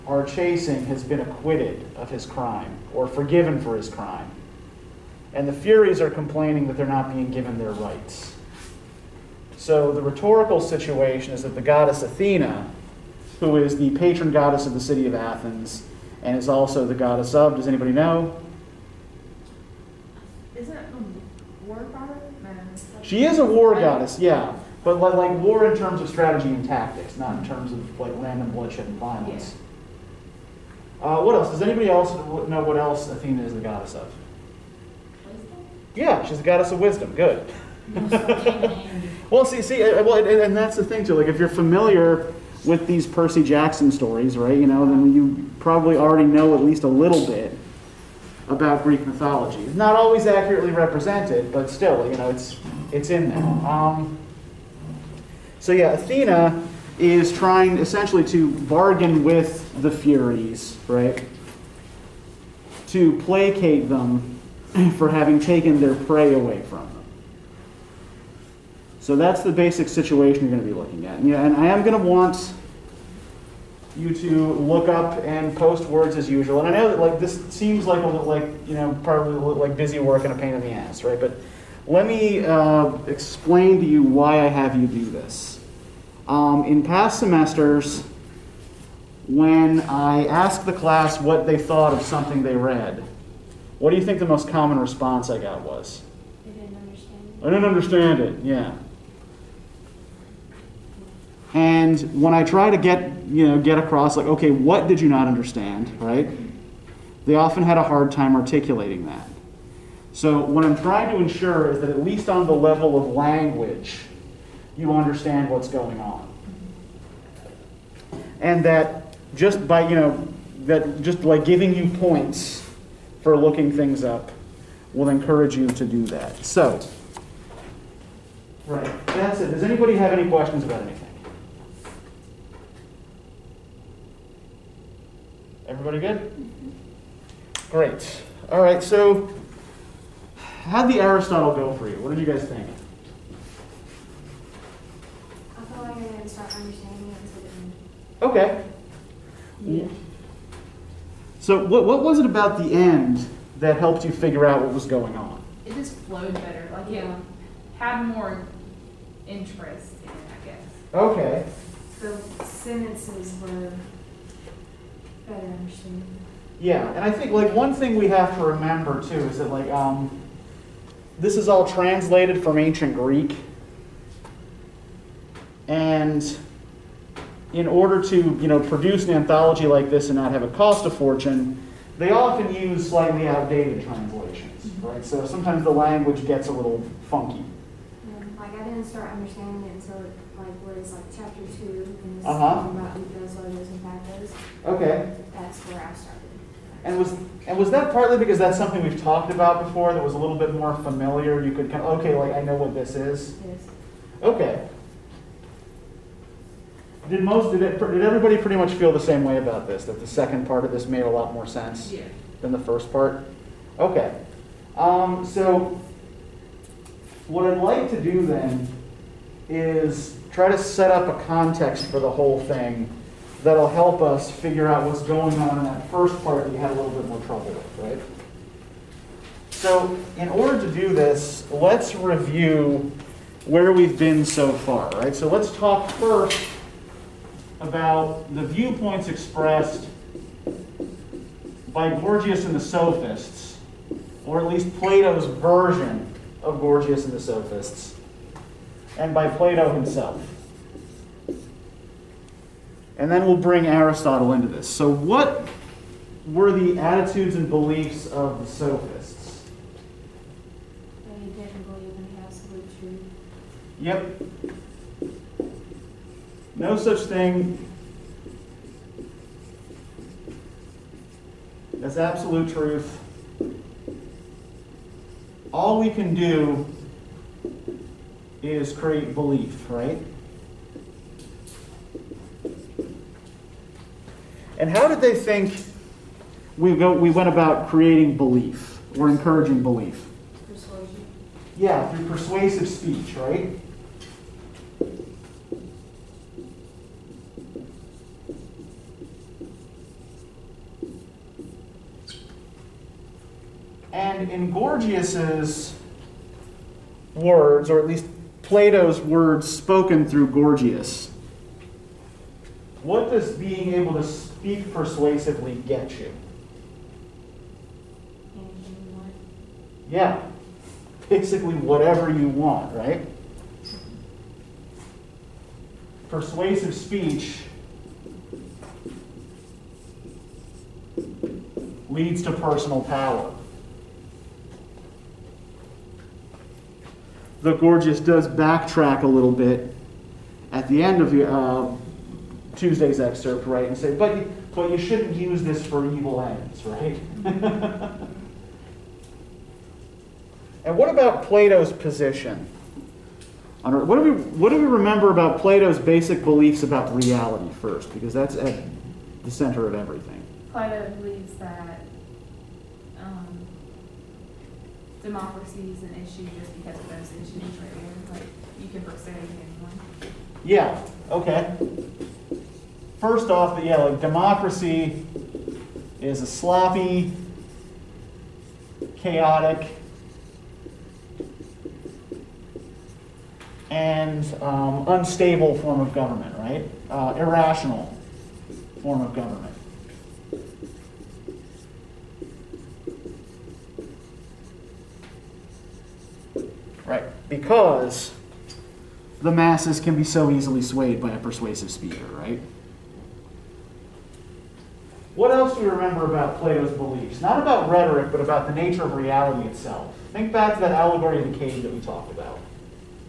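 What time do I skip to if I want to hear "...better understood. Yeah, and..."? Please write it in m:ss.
2:45.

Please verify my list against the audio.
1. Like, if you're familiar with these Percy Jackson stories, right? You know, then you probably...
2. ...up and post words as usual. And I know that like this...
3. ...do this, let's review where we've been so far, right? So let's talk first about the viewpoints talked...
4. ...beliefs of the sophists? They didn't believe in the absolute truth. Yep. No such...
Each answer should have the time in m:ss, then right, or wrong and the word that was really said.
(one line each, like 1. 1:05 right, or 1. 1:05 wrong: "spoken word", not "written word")
1. 0:41 right
2. 1:14 right
3. 3:50 wrong: "expressed", not "talked"
4. 4:17 right.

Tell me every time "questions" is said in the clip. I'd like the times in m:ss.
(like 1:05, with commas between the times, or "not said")
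2:10.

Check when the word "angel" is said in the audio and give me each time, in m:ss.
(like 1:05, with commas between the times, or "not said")
not said.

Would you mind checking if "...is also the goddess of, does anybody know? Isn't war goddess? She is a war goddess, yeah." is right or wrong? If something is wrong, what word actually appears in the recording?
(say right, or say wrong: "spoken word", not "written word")
right.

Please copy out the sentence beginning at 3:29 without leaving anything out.
That the second part of this made a lot more sense yeah.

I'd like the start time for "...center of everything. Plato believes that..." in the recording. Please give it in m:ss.
5:59.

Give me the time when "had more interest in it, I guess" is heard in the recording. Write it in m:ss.
2:37.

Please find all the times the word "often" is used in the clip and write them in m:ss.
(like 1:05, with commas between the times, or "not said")
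1:47, 3:02.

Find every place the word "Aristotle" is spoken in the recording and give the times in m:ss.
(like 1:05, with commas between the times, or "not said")
2:21, 4:13.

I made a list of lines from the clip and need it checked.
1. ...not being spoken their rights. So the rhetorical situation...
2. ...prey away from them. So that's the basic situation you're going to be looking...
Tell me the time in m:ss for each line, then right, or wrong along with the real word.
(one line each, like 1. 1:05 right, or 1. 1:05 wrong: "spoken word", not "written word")
1. 0:06 wrong: "given", not "spoken"
2. 1:05 right.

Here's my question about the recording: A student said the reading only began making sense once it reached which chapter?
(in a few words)
chapter two.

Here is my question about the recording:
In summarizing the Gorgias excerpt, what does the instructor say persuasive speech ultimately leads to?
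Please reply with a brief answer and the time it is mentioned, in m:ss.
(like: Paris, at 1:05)
personal power, at 5:32.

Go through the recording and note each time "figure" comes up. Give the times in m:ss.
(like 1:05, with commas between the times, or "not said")
2:34, 3:44.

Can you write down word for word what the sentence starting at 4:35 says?
All we can do is create belief, right?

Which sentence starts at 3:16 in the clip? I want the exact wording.
And was and was that partly because that's something we've talked about before that was a little bit more familiar?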